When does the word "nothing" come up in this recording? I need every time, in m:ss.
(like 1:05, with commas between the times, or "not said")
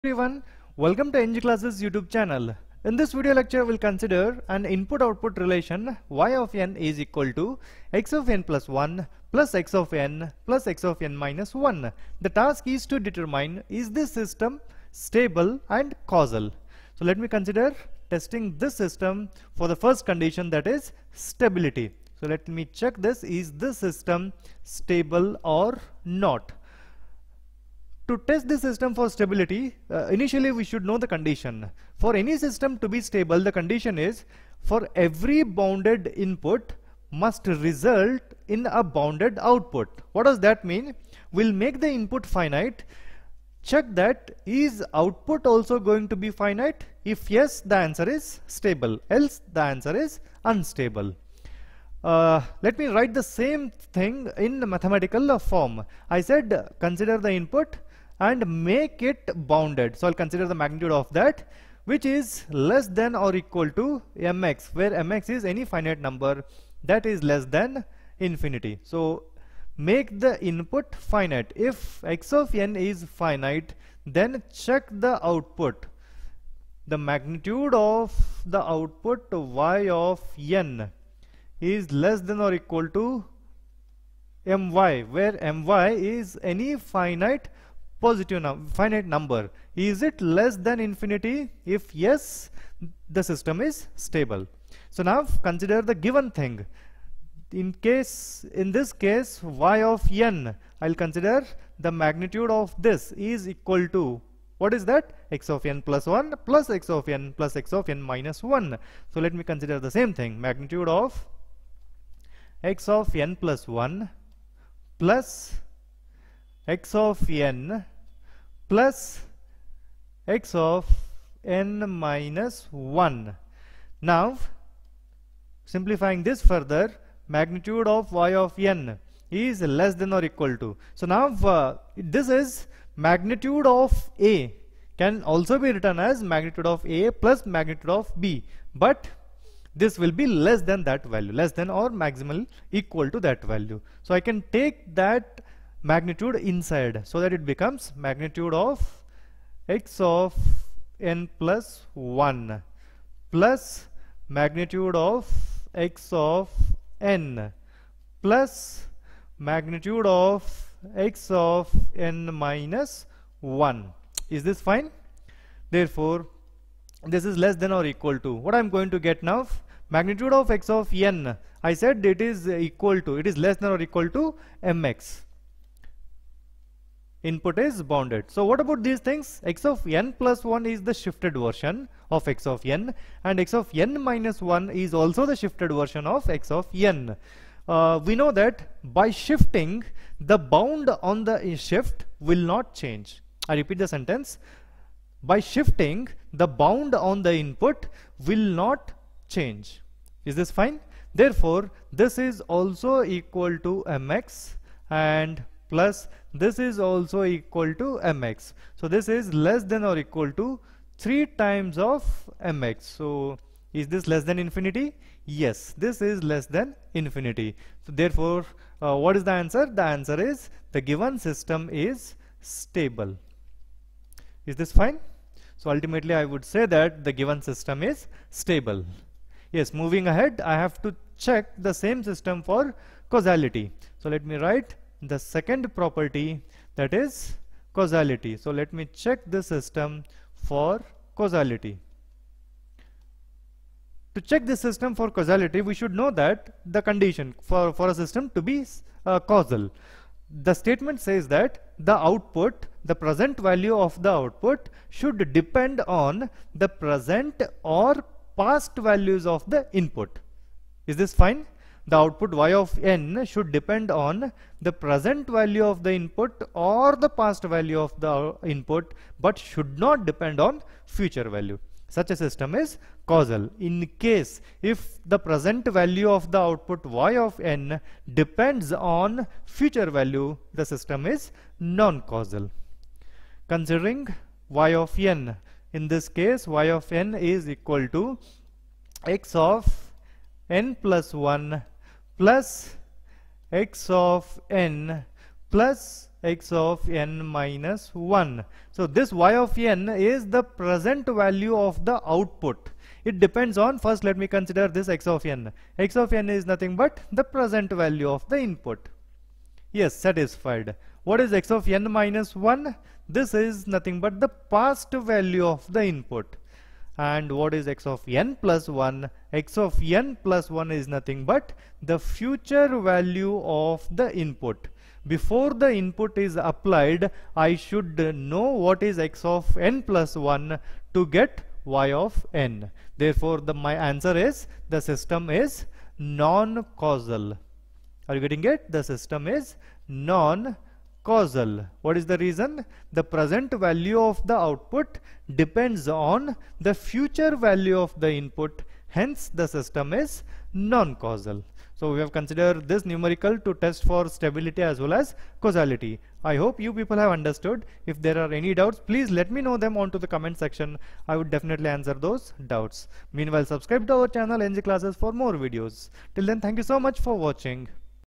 5:06, 5:13, 5:20.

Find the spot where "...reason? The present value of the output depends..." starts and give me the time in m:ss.
5:42.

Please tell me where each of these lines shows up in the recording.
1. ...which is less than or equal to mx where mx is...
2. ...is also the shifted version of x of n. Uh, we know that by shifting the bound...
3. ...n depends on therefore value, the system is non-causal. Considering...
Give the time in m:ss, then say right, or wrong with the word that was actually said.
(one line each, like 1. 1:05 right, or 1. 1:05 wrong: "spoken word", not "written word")
1. 1:01 right
2. 3:04 right
3. 4:37 wrong: "future", not "therefore".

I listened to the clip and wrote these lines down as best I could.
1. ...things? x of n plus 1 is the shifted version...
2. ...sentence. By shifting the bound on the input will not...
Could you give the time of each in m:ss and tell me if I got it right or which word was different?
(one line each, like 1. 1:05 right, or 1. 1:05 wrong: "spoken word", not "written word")
1. 2:58 right
2. 3:13 right.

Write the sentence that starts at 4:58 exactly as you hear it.
So this y of n is the present value of the output.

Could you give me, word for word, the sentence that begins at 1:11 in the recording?
If x of n is finite then check the output.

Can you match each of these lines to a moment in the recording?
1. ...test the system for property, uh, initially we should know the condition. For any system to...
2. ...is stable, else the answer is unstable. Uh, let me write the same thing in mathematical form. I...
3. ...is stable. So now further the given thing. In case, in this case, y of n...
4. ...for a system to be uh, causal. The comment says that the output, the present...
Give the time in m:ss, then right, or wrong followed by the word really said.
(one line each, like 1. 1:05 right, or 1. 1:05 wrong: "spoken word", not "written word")
1. 0:28 wrong: "stability", not "property"
2. 0:48 right
3. 1:33 wrong: "consider", not "further"
4. 4:07 wrong: "statement", not "comment".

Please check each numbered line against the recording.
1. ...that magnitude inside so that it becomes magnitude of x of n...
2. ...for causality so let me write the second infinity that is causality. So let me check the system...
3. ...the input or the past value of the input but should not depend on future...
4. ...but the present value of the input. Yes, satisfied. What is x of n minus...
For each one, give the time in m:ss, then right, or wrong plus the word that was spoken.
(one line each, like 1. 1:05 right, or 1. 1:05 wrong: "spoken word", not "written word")
1. 2:24 right
2. 3:52 wrong: "property", not "infinity"
3. 4:25 right
4. 5:06 right.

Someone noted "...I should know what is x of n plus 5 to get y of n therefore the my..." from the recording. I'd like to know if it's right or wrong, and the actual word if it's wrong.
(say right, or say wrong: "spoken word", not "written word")
wrong: "1", not "5".